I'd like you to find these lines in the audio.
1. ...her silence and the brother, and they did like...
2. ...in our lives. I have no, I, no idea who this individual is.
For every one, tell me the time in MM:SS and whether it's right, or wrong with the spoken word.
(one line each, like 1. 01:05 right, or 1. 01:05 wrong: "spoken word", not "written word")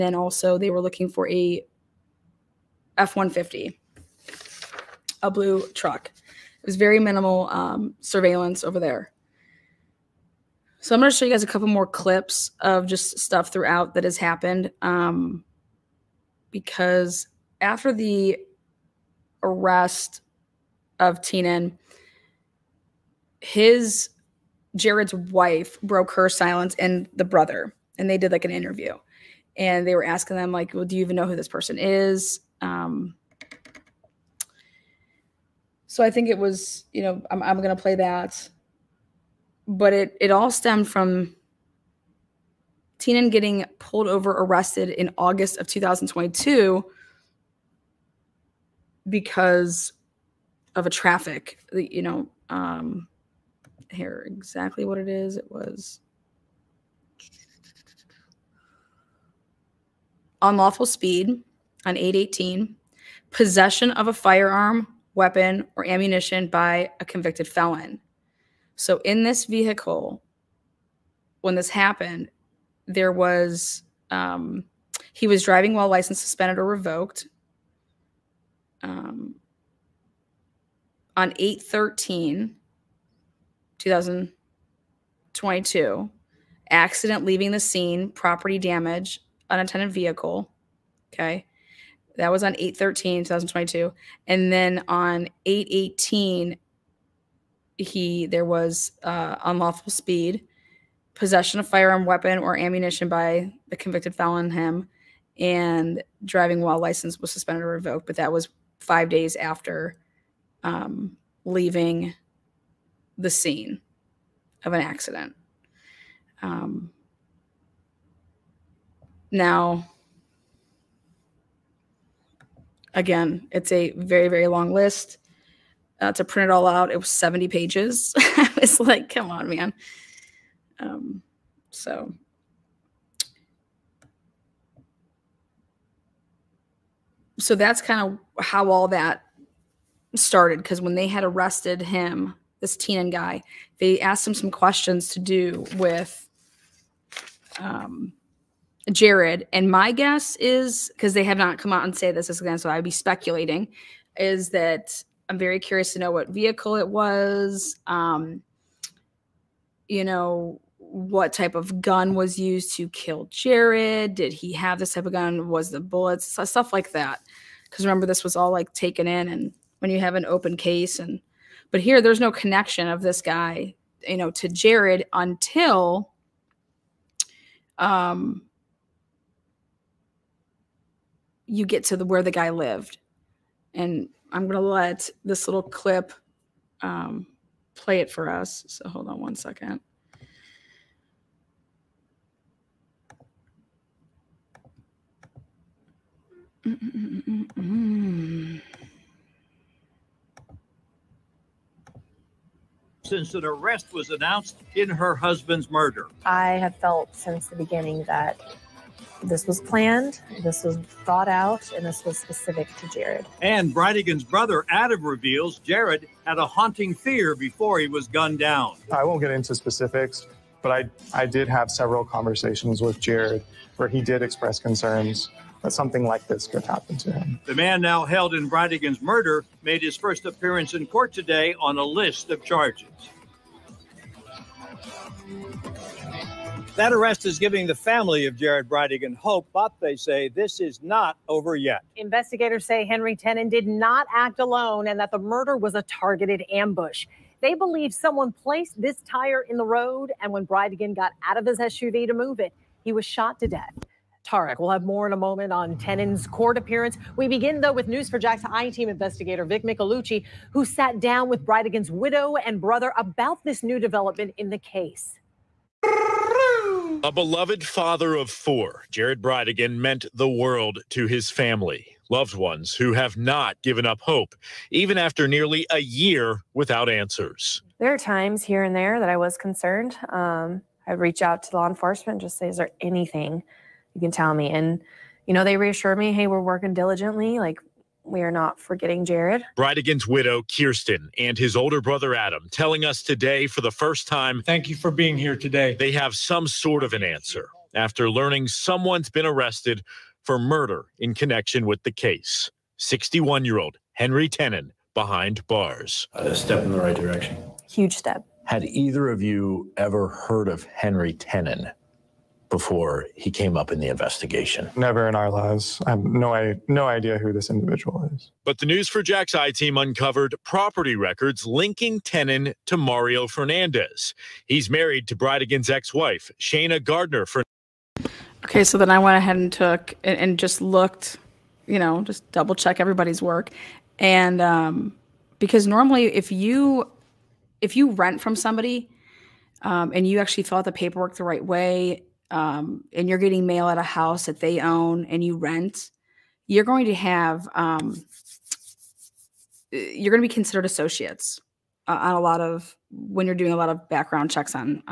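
1. 00:26 right
2. 05:15 right.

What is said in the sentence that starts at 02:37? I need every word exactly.
Um, you know, what type of gun was used to kill Jared?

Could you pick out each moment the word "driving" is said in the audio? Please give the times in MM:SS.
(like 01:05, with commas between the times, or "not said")
01:15, 01:46.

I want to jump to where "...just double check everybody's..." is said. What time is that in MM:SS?
05:32.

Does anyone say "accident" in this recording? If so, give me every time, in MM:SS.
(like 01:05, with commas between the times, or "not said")
01:26, 01:54.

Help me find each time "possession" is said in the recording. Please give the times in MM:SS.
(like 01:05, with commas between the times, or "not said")
01:03, 01:41.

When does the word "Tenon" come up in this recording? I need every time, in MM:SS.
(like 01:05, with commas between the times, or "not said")
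04:03, 04:15, 05:04, 05:11, 05:22.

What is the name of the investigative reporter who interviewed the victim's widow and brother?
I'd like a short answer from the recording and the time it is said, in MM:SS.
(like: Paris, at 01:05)
Vic Micolucci, at 04:19.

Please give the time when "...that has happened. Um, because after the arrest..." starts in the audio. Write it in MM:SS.
00:13.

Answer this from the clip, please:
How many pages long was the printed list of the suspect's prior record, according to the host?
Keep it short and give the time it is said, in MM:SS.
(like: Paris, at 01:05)
70, at 02:07.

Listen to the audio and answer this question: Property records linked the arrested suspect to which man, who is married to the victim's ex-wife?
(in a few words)
Mario Fernandez.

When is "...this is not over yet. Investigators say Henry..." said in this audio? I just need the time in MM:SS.
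04:00.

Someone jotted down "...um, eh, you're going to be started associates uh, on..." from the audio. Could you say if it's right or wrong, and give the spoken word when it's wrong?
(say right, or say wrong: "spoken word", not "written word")
wrong: "considered", not "started".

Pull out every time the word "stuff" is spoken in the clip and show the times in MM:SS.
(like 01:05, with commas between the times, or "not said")
00:13, 02:46.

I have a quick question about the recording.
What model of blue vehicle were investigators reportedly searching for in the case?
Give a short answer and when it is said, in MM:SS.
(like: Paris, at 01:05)
F-150, at 00:02.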